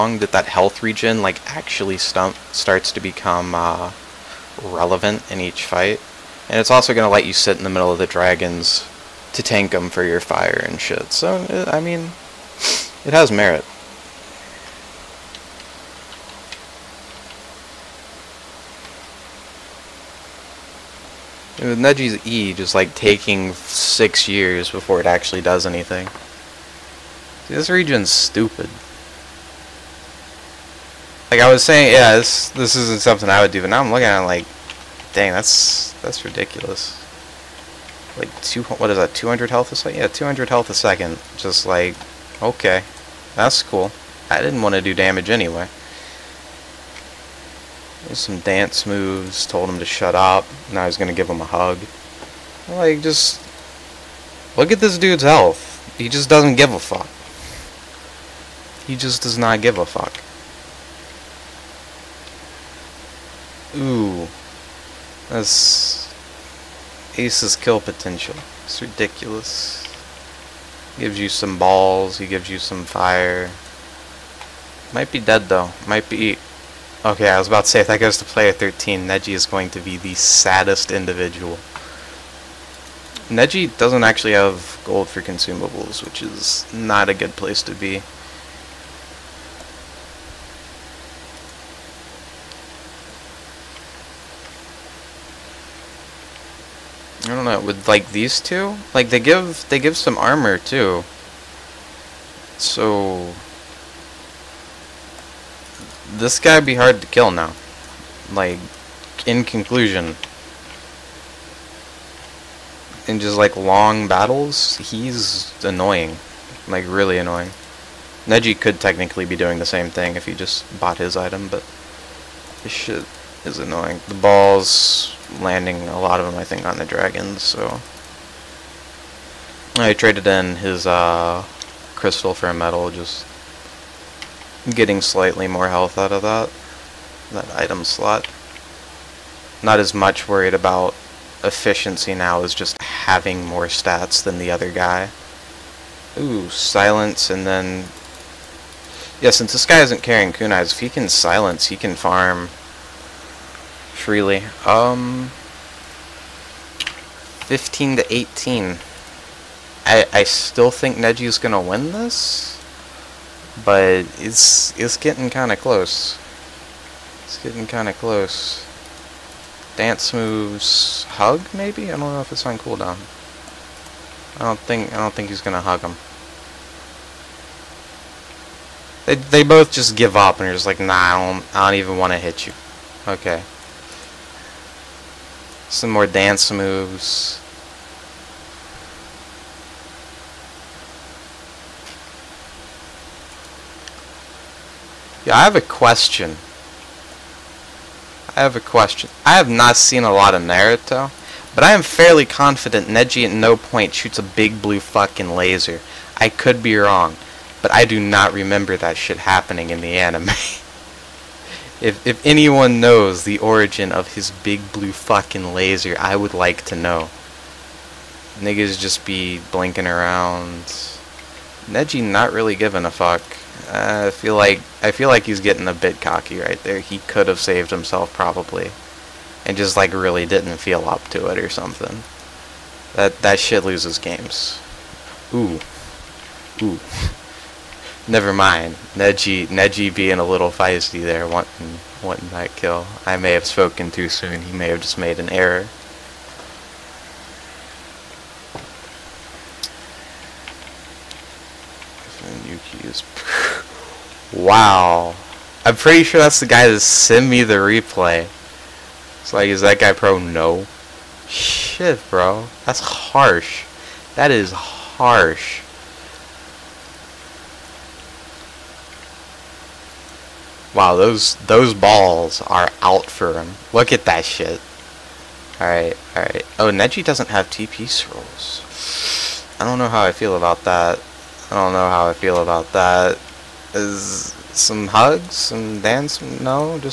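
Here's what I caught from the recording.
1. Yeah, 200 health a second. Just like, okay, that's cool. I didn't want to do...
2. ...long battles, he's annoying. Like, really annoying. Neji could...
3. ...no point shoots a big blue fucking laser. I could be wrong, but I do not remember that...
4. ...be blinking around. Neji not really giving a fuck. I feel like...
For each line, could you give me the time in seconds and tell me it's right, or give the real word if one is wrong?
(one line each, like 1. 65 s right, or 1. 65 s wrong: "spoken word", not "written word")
1. 39 s right
2. 113 s right
3. 203 s right
4. 219 s right.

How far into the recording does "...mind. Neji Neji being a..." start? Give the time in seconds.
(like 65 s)
238 s.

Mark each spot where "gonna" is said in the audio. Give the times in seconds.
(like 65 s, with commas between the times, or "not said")
161 s, 175 s.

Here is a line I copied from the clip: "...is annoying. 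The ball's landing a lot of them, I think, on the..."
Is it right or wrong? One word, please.
right.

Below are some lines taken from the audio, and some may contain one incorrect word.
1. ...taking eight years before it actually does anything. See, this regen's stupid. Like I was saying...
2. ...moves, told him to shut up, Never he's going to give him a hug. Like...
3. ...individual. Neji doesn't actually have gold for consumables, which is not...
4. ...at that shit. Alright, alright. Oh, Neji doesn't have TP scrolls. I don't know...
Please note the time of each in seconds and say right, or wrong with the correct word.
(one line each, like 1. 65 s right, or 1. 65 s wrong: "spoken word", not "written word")
1. 22 s wrong: "six", not "eight"
2. 48 s wrong: "Now", not "Never"
3. 80 s right
4. 273 s right.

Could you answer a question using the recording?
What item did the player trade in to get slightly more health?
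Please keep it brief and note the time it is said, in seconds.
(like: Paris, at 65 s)
crystal, at 131 s.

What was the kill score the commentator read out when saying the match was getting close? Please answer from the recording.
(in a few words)
15 to 18.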